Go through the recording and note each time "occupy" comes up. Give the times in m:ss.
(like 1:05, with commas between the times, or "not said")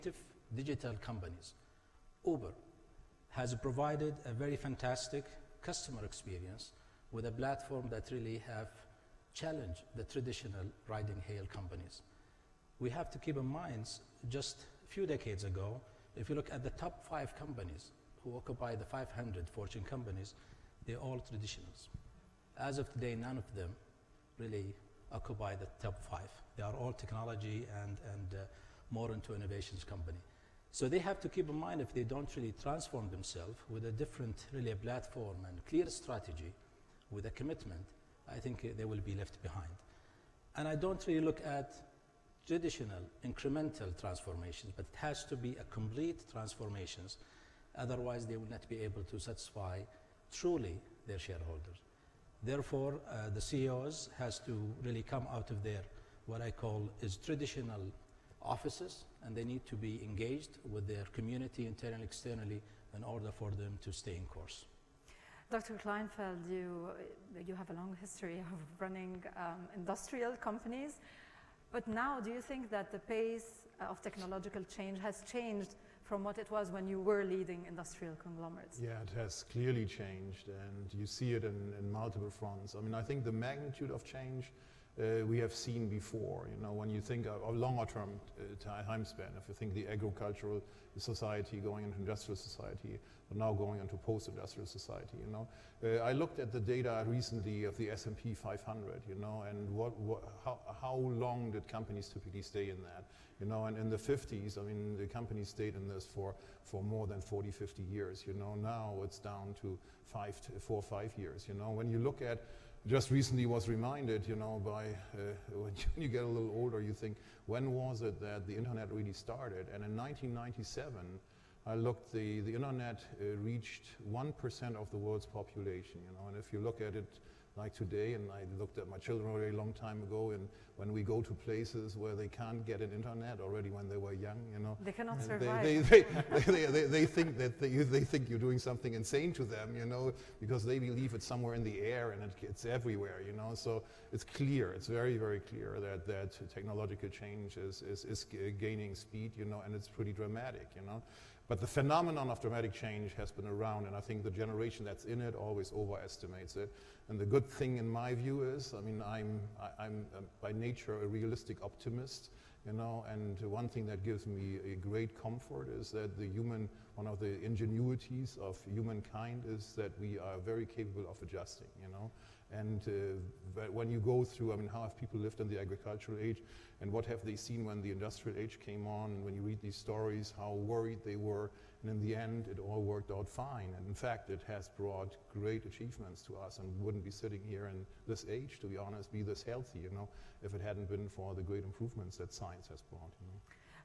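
0:18, 0:25.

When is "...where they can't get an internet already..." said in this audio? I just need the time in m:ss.
2:11.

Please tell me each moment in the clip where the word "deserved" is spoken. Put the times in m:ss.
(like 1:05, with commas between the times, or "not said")
not said.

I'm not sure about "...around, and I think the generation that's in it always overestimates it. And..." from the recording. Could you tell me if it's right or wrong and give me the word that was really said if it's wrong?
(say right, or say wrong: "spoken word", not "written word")
right.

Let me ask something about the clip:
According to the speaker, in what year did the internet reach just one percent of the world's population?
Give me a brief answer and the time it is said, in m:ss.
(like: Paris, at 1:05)
1997, at 1:59.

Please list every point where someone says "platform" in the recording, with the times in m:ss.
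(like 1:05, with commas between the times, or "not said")
0:07, 0:34.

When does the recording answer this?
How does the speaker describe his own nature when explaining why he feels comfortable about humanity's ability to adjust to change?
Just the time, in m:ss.
2:41.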